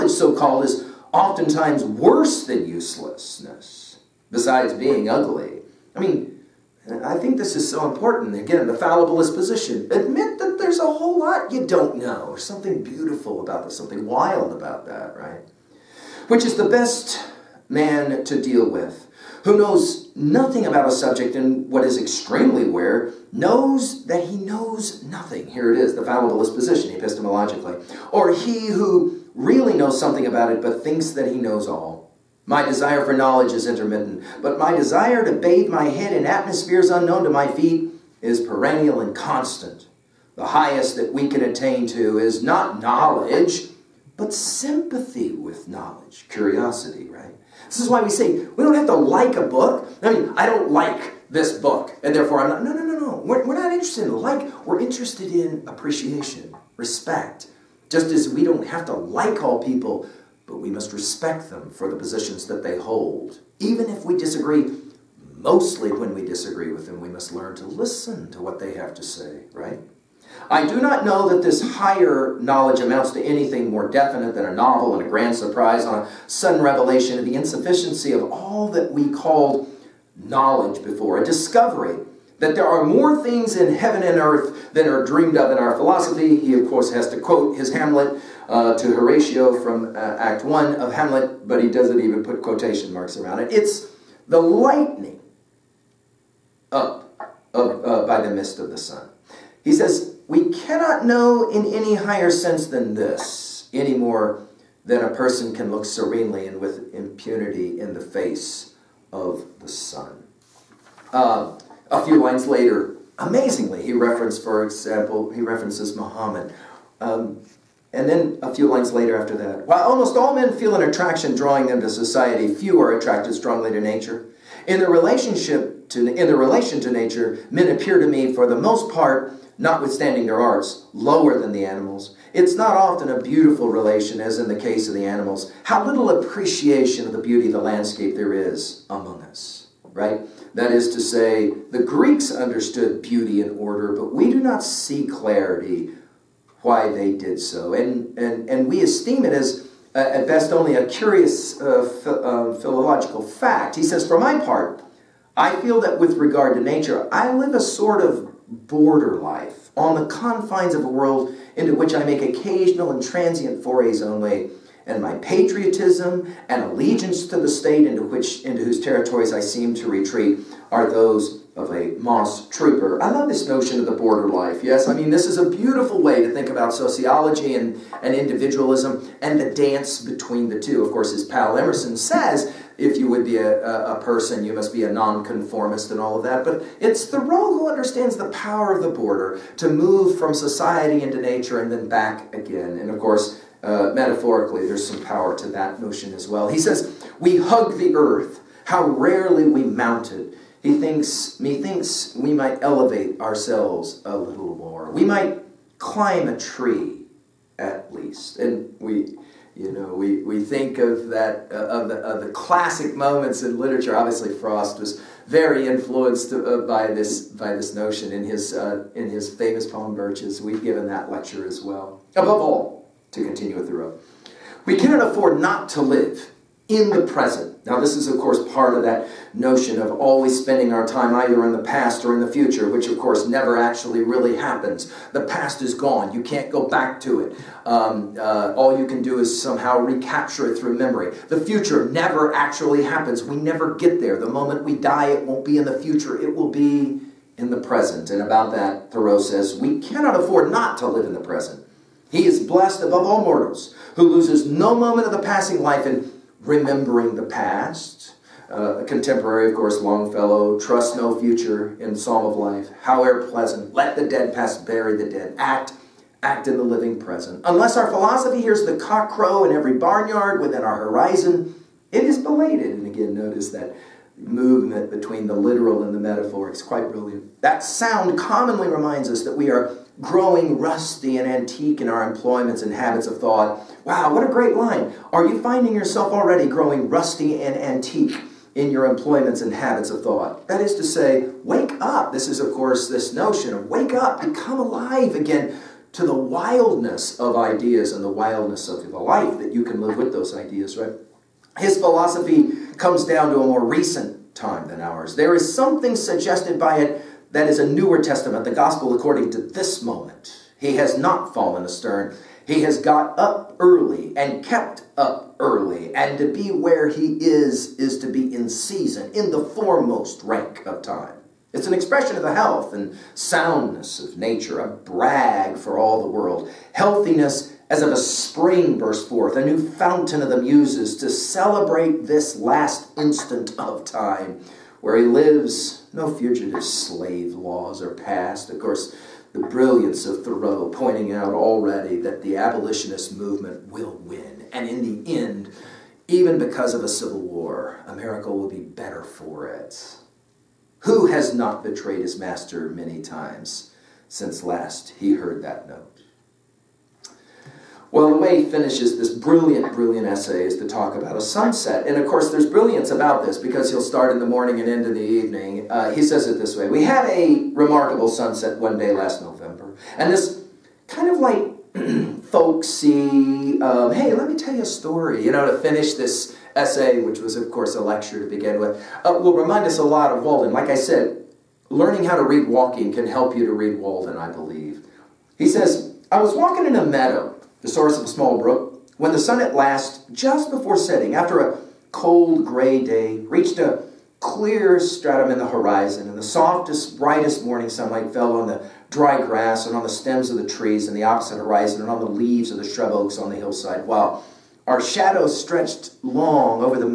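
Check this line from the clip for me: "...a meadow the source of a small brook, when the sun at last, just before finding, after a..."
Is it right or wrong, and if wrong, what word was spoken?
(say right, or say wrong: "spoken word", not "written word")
wrong: "setting", not "finding".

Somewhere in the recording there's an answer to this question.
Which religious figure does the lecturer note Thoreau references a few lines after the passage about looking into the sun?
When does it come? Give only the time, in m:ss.
1:55.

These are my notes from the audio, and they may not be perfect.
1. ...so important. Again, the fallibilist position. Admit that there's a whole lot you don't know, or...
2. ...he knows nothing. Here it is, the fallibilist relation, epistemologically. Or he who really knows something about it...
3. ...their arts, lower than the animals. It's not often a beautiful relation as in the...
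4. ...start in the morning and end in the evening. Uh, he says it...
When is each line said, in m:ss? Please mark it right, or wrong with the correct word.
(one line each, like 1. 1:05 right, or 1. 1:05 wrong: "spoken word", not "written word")
1. 0:07 right
2. 0:24 wrong: "position", not "relation"
3. 2:10 right
4. 6:03 right.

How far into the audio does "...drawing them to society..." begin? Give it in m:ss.
2:01.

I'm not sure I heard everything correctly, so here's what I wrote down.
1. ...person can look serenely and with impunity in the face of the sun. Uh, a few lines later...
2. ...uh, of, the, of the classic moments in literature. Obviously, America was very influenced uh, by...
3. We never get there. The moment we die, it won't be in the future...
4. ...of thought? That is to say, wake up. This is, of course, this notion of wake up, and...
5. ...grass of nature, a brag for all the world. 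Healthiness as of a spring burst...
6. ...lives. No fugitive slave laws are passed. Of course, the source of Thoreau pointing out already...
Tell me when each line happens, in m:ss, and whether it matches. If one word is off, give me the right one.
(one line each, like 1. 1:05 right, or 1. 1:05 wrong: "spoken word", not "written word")
1. 1:45 right
2. 3:31 wrong: "Frost", not "America"
3. 4:03 right
4. 4:49 right
5. 5:23 wrong: "soundness", not "grass"
6. 5:35 wrong: "brilliance", not "source".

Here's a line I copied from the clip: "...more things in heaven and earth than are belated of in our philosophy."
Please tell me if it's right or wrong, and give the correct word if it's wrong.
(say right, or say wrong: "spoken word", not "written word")
wrong: "dreamed", not "belated".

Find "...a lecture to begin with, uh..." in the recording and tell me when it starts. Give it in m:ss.
6:17.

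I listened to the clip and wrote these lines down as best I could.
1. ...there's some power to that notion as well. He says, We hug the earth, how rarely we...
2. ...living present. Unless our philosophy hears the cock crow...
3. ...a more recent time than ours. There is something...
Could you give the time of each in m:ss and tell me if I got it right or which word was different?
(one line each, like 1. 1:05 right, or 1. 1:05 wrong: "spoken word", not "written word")
1. 3:14 right
2. 4:26 right
3. 5:03 right.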